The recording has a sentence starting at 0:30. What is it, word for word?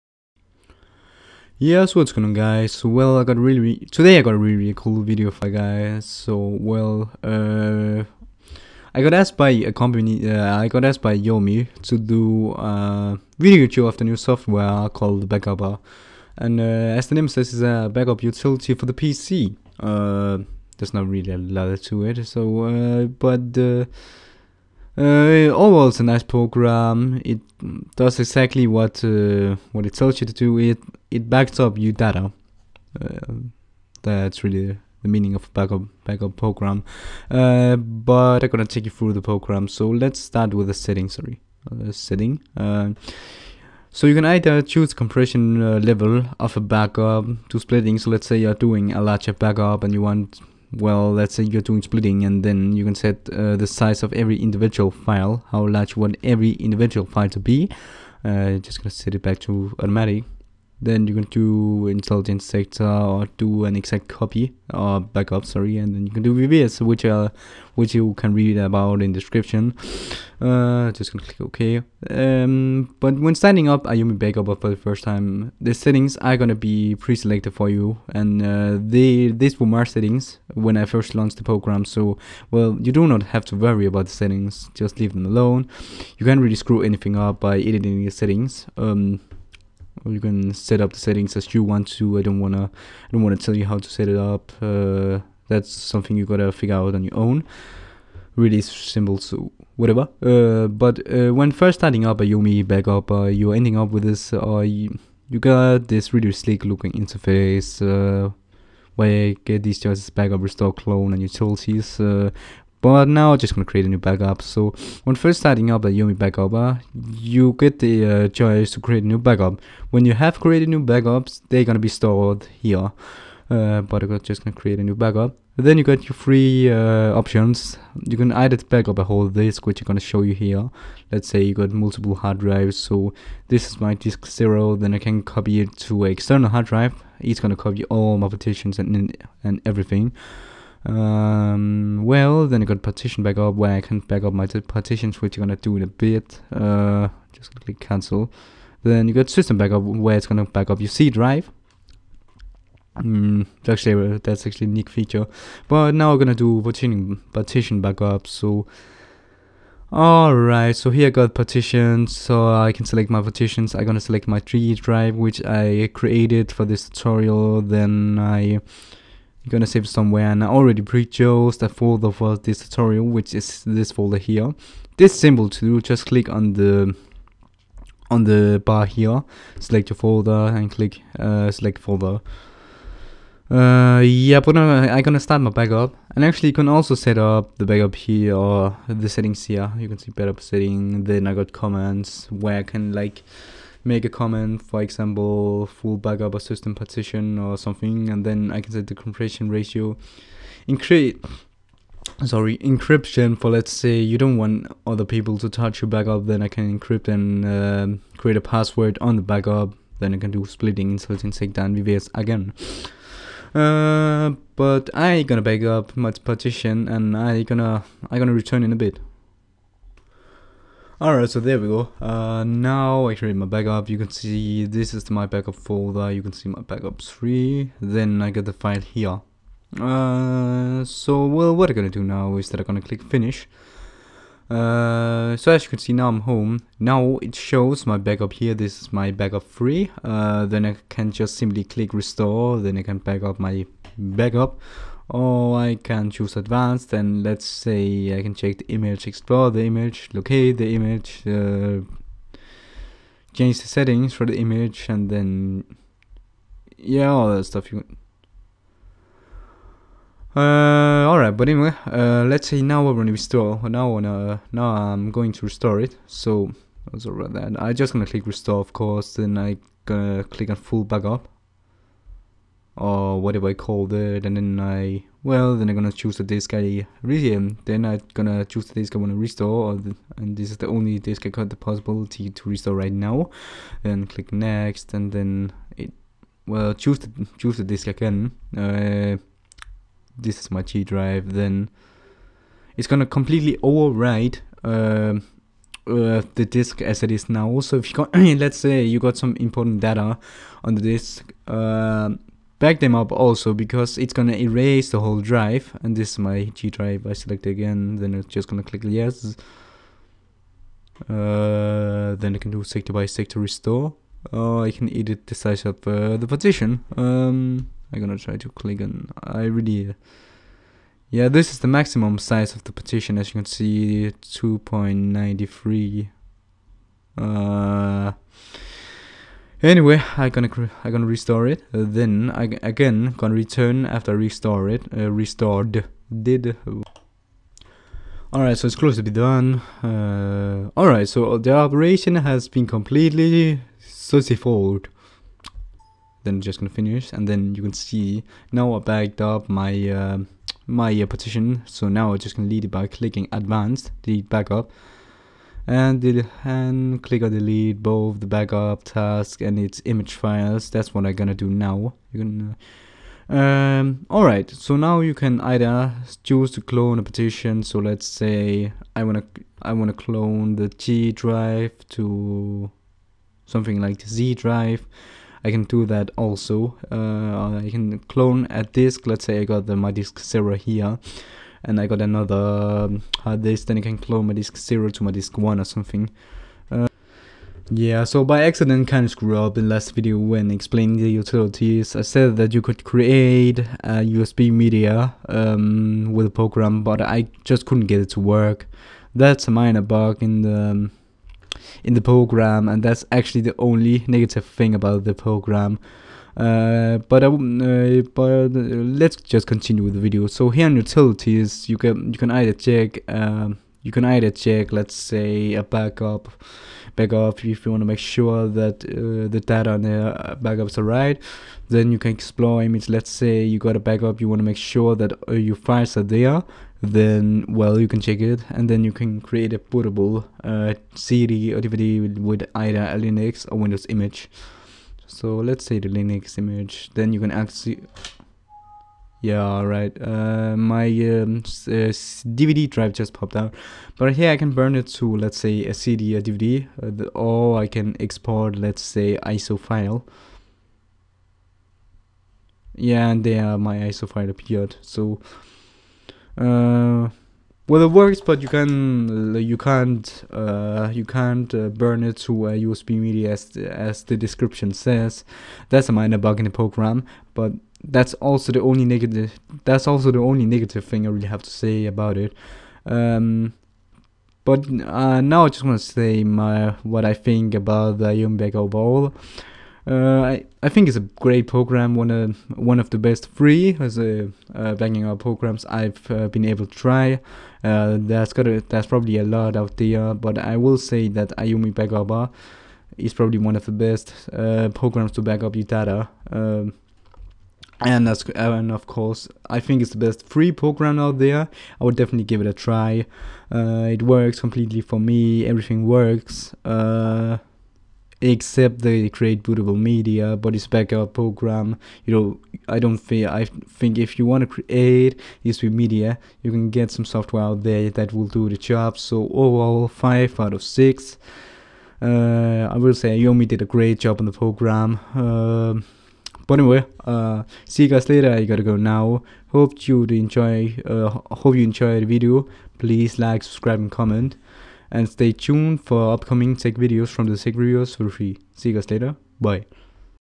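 It it backs up your data.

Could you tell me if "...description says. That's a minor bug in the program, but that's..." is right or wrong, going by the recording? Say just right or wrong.
right.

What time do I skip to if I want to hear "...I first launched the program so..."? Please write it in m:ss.
1:20.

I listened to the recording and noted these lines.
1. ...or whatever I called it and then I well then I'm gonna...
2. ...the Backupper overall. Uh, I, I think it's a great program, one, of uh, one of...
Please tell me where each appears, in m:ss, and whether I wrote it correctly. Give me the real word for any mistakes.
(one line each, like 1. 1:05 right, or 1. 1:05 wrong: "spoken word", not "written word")
1. 4:32 right
2. 7:57 wrong: "Yumbeck", not "Backupper".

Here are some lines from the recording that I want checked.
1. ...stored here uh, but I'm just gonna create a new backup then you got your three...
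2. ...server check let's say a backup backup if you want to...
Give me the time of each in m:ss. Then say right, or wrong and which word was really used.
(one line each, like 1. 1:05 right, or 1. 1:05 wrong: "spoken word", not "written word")
1. 2:01 right
2. 6:54 wrong: "either", not "server".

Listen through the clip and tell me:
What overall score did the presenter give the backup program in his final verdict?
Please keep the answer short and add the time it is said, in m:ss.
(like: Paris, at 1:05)
5 out of 6, at 8:39.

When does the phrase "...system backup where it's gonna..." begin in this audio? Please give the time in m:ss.
2:29.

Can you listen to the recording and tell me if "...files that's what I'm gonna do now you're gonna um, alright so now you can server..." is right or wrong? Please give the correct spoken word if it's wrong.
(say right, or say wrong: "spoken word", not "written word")
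wrong: "either", not "server".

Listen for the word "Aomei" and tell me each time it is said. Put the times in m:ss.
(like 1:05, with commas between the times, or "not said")
0:11, 1:13, 1:42, 1:55, 8:11, 8:43.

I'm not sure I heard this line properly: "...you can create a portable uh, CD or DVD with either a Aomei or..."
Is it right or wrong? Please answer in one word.
wrong.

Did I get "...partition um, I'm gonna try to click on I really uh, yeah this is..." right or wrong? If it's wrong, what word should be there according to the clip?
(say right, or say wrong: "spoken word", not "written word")
right.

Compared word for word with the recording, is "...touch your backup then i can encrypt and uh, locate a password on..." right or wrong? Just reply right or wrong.
wrong.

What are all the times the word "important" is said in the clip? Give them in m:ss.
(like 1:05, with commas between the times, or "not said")
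4:59.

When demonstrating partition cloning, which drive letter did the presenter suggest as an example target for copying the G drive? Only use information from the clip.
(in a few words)
Z.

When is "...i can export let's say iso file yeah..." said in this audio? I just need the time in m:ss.
7:27.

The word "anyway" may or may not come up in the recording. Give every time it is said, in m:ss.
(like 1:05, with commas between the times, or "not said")
4:21, 5:29, 8:46.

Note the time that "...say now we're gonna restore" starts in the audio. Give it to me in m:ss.
4:22.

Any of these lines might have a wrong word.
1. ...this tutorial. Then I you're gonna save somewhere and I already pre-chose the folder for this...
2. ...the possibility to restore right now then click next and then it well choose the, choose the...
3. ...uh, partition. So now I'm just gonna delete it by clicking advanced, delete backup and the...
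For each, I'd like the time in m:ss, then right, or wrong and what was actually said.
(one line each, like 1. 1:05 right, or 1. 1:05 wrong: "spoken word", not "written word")
1. 2:46 right
2. 4:41 right
3. 5:50 right.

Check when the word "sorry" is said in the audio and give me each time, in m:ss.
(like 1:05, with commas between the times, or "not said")
0:41, 1:05, 3:22, 4:26.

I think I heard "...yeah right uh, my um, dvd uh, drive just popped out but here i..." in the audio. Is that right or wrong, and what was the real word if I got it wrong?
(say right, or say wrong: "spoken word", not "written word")
right.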